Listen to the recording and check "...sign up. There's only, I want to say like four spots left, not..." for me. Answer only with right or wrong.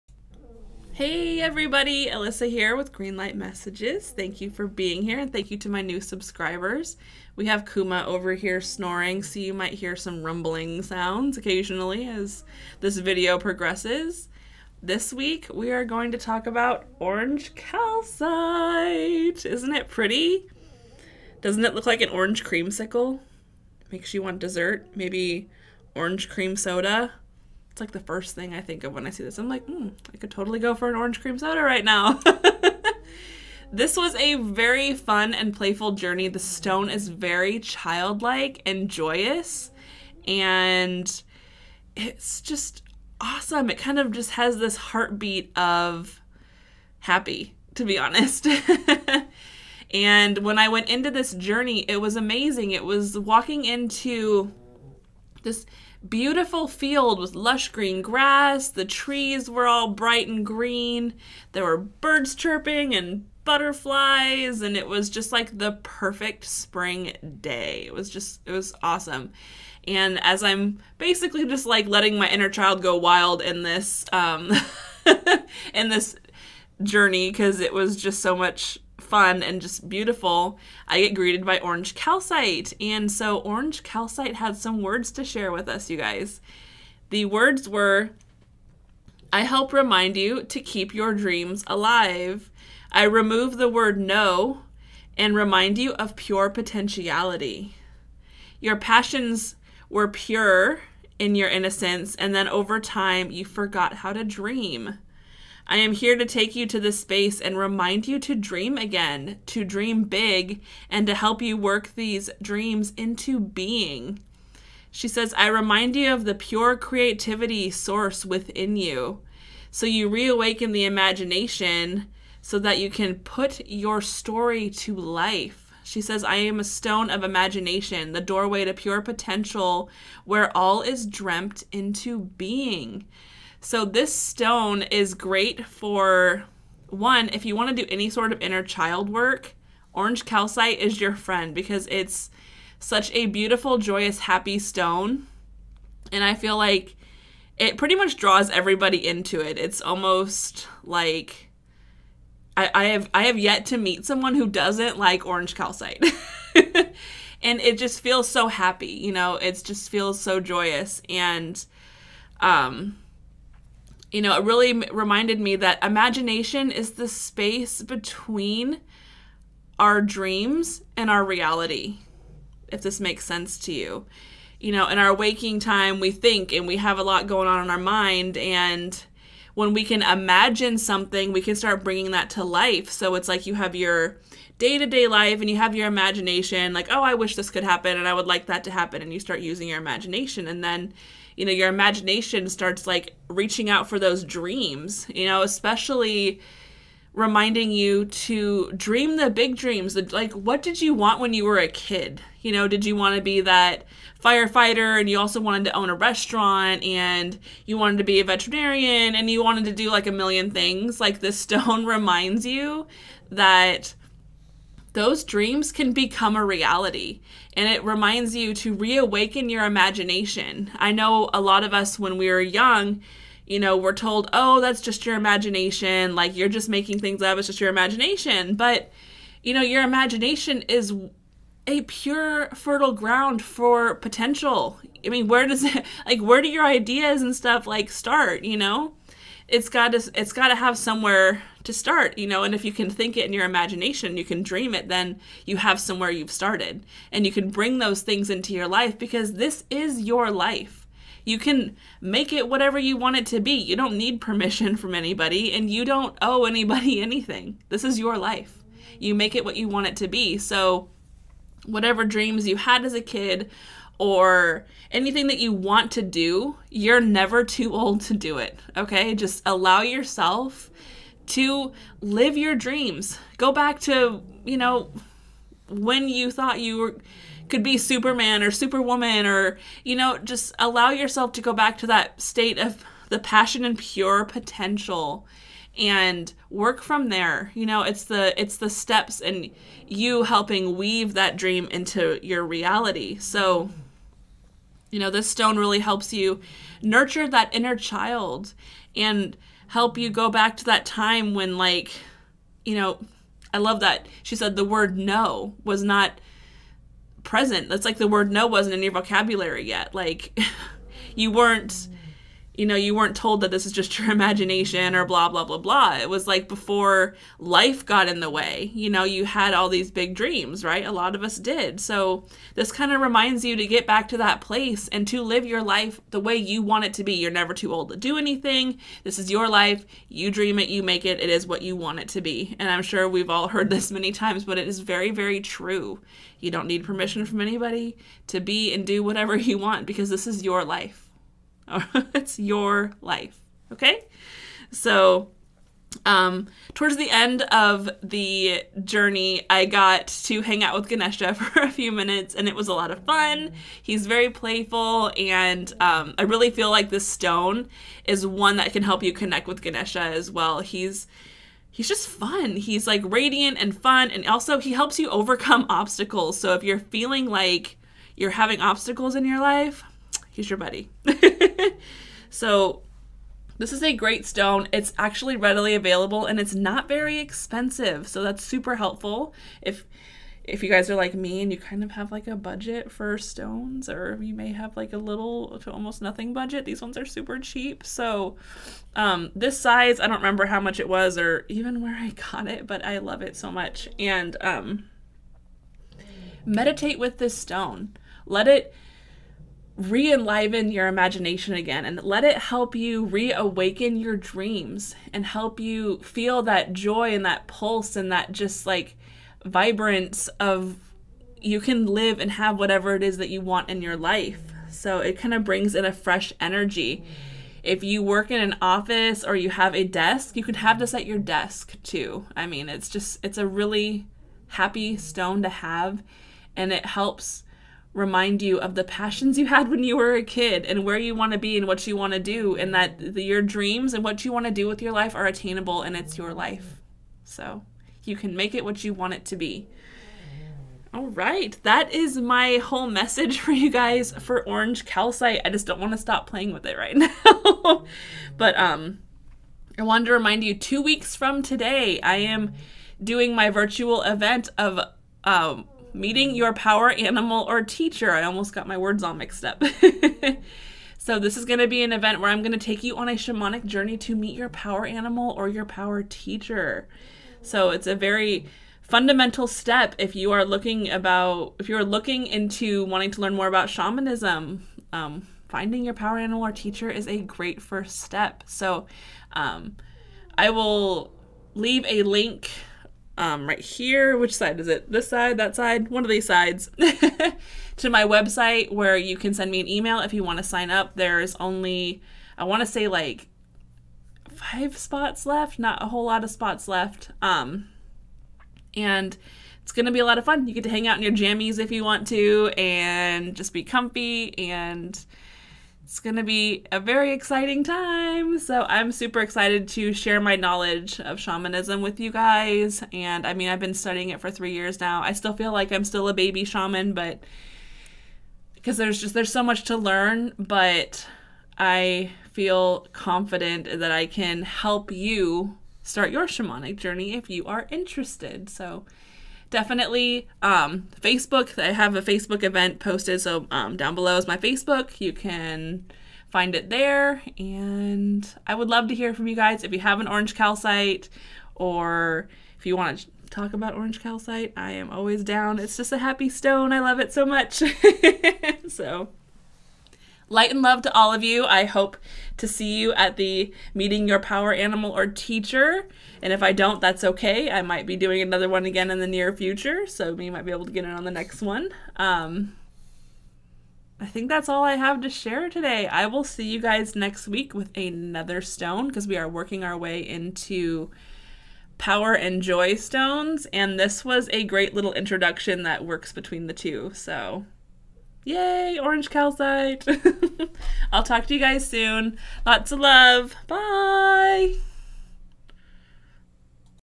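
wrong.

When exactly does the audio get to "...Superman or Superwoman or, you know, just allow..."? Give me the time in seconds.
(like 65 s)
277 s.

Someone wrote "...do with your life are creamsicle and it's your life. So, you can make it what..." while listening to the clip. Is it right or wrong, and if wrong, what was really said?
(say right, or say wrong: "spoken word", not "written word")
wrong: "attainable", not "creamsicle".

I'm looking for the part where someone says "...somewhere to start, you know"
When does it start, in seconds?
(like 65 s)
240 s.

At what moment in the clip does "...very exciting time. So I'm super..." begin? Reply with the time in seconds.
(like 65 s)
506 s.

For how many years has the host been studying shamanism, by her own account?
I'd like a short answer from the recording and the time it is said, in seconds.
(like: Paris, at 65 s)
3, at 514 s.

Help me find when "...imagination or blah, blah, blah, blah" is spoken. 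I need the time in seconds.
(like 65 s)
314 s.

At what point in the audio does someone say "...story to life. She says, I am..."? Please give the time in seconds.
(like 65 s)
124 s.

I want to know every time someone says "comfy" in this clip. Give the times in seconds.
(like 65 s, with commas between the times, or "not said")
503 s.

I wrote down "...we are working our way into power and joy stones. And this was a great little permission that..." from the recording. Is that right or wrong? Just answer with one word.
wrong.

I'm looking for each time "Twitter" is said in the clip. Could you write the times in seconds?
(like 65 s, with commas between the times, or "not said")
not said.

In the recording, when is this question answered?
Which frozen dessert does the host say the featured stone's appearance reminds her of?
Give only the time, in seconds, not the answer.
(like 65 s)
22 s.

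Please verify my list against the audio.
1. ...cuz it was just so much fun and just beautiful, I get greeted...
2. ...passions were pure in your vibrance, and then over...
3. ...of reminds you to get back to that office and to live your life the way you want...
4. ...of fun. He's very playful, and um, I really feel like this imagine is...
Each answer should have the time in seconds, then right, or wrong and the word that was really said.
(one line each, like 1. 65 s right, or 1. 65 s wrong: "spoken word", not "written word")
1. 77 s right
2. 98 s wrong: "innocence", not "vibrance"
3. 322 s wrong: "place", not "office"
4. 352 s wrong: "stone", not "imagine".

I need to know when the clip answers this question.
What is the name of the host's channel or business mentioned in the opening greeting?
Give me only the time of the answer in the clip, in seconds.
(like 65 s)
2 s.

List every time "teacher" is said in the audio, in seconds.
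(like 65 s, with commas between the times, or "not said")
457 s, 466 s, 476 s, 555 s.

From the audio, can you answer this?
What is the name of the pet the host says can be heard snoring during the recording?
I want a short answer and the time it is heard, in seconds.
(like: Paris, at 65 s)
Kuma, at 7 s.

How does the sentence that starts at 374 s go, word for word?
It's actually readily available and it's not very expensive.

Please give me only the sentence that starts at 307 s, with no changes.
That's like the word no wasn't in your vocabulary yet.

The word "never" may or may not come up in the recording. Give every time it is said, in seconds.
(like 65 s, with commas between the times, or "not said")
267 s, 327 s.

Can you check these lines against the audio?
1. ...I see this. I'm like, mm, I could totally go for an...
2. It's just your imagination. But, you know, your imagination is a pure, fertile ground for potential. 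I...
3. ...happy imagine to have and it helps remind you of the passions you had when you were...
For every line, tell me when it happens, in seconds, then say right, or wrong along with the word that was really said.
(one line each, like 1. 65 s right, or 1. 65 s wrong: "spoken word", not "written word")
1. 29 s right
2. 227 s right
3. 424 s wrong: "stone", not "imagine".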